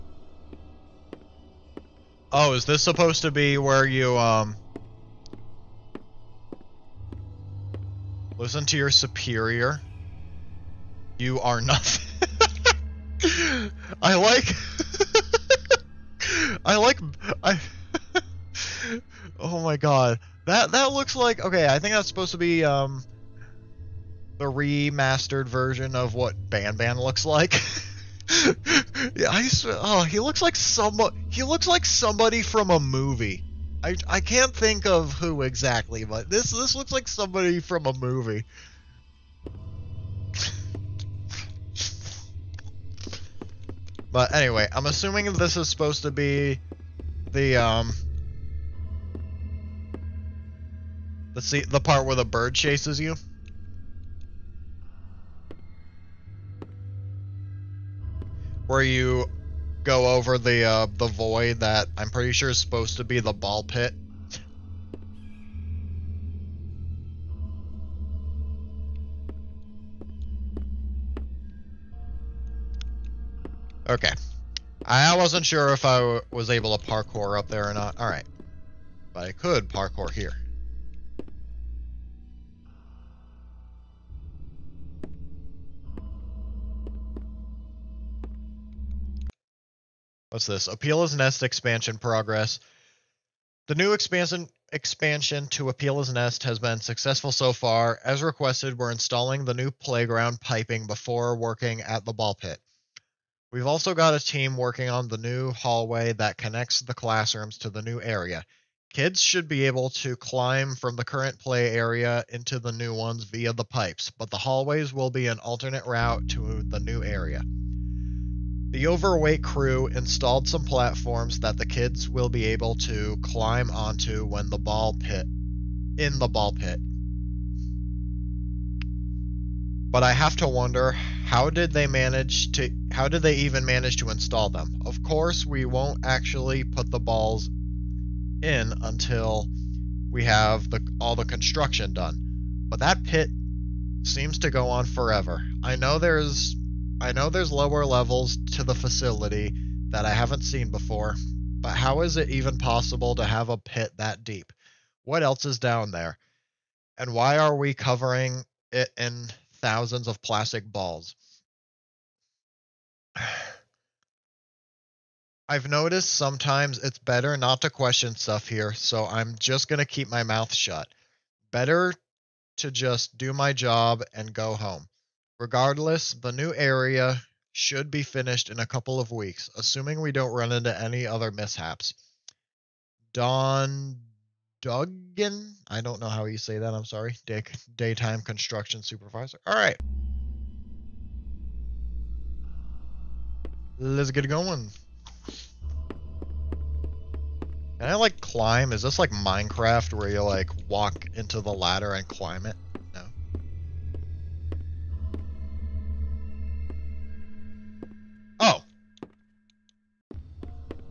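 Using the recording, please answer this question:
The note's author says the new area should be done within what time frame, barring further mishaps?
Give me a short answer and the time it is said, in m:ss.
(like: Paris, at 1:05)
A couple of weeks, at 2:58.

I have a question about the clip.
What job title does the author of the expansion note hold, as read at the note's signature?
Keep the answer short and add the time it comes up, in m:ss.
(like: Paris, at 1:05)
Daytime construction supervisor, at 3:07.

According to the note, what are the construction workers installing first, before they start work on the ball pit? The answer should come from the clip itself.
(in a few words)
New playground piping.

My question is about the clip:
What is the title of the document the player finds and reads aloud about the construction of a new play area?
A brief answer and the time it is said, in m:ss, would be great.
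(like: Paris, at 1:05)
Opila's Nest expansion progress, at 1:30.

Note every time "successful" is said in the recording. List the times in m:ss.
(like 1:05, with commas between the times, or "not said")
1:36.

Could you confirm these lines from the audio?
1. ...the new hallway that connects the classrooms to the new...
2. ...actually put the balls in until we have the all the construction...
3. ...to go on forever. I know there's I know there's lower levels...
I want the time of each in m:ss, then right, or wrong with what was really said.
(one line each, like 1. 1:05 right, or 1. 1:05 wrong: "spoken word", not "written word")
1. 1:45 right
2. 2:16 right
3. 2:24 right.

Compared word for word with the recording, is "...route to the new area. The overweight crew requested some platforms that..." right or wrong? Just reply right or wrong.
wrong.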